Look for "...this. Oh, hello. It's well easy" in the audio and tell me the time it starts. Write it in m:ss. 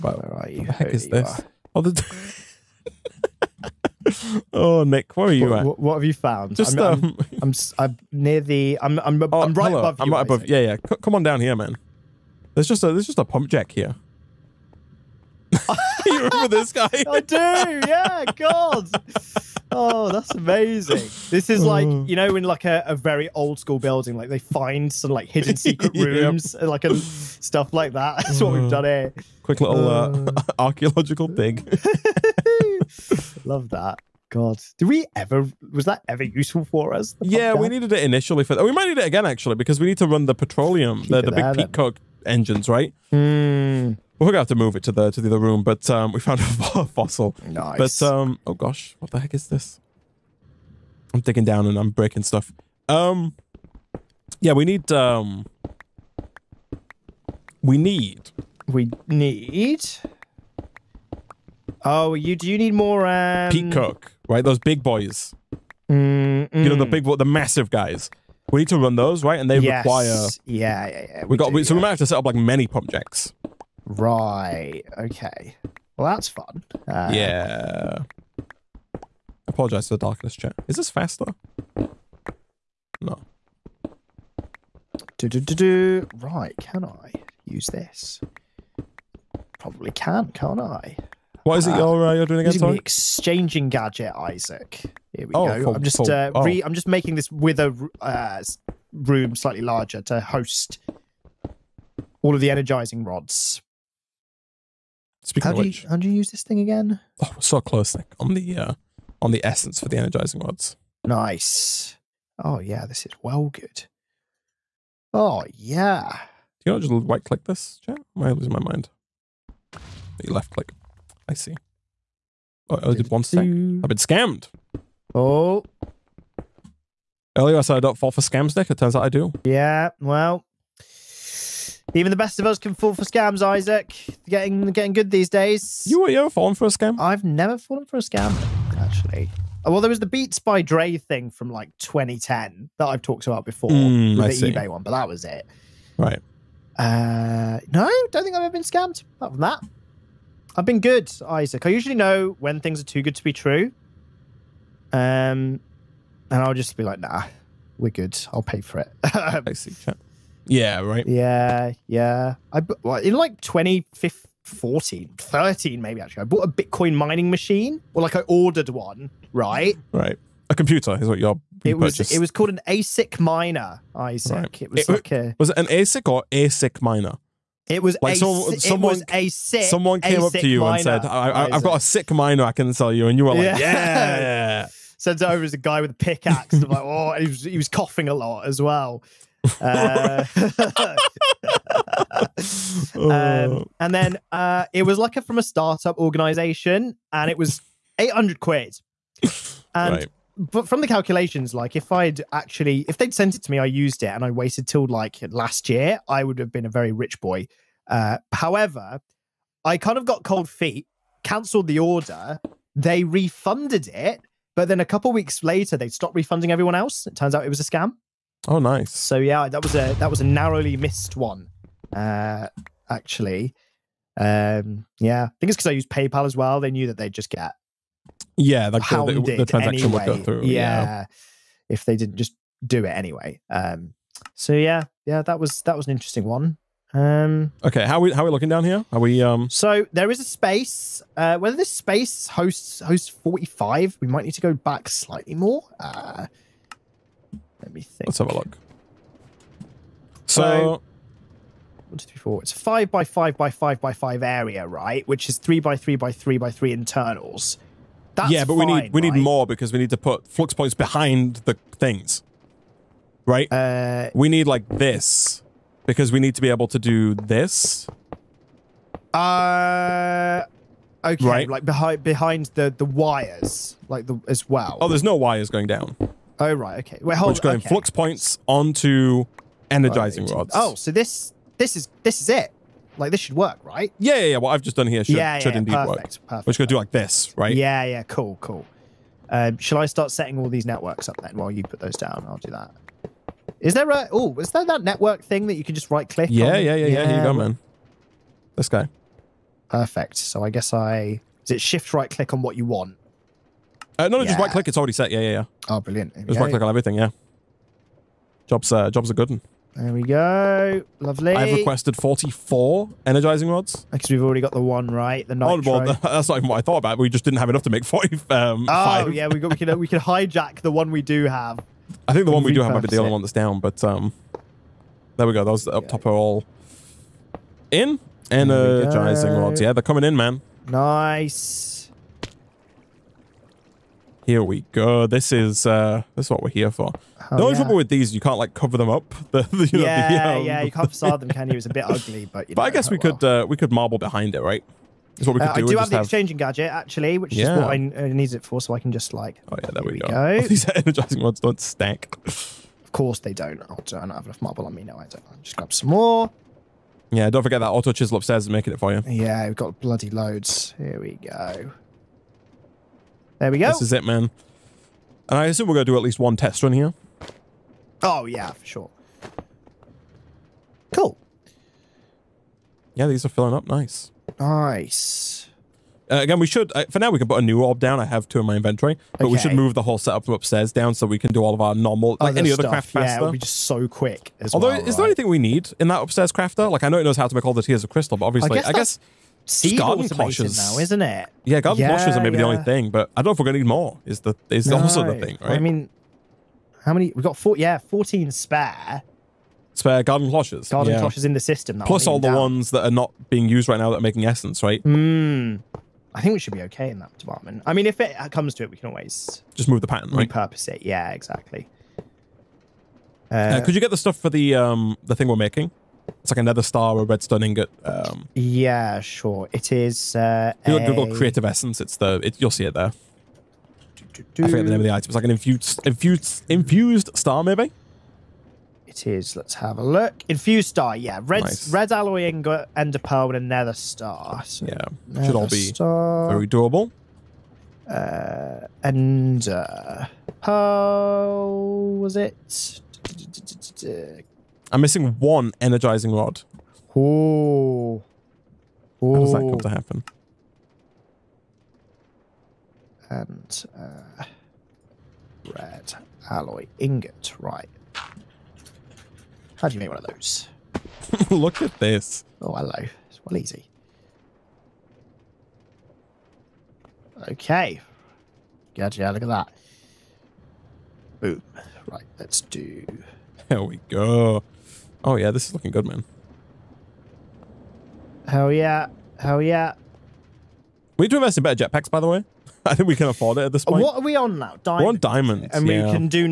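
7:41.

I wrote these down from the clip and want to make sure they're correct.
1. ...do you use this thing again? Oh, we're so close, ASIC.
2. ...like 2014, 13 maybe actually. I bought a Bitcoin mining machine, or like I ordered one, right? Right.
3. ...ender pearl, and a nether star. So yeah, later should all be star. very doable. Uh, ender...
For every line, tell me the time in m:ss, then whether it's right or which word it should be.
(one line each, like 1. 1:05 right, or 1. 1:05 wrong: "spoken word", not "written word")
1. 1:45 wrong: "Nick", not "ASIC"
2. 2:43 right
3. 7:12 wrong: "nether", not "later".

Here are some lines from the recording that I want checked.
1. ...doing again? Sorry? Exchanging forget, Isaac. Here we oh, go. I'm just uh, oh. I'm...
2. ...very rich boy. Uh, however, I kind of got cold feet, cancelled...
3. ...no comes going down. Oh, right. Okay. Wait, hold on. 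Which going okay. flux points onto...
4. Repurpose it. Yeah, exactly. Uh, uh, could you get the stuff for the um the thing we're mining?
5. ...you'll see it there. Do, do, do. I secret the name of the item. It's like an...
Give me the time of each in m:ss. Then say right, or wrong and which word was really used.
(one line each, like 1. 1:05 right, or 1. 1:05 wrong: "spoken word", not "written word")
1. 1:32 wrong: "gadget", not "forget"
2. 3:26 right
3. 4:35 wrong: "wires", not "comes"
4. 6:50 wrong: "making", not "mining"
5. 7:02 wrong: "forget", not "secret".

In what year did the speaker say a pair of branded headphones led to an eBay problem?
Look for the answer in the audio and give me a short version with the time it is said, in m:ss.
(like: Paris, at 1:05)
2010, at 2:21.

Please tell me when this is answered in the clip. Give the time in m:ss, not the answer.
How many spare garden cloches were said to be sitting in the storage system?
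6:37.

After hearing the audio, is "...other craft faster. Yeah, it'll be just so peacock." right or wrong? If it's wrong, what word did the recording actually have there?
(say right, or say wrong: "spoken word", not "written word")
wrong: "quick", not "peacock".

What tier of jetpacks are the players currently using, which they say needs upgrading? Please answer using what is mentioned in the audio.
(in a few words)
Diamond.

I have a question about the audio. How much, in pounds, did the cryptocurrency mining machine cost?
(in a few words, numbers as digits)
800.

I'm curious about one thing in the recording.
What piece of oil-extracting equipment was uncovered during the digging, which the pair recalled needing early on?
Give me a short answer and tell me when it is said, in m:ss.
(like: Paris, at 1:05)
pump jack, at 0:13.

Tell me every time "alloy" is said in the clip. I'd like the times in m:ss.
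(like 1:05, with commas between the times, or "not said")
7:11, 7:36.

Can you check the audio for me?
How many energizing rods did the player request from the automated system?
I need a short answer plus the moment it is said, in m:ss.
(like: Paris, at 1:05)
44, at 5:11.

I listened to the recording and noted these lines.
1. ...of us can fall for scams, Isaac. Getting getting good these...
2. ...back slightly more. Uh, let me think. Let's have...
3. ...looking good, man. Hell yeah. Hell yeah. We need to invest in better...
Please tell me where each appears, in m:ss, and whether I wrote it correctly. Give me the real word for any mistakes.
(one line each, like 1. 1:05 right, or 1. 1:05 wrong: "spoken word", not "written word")
1. 2:12 right
2. 4:04 right
3. 7:55 right.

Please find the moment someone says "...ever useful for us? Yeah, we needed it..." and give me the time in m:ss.
0:36.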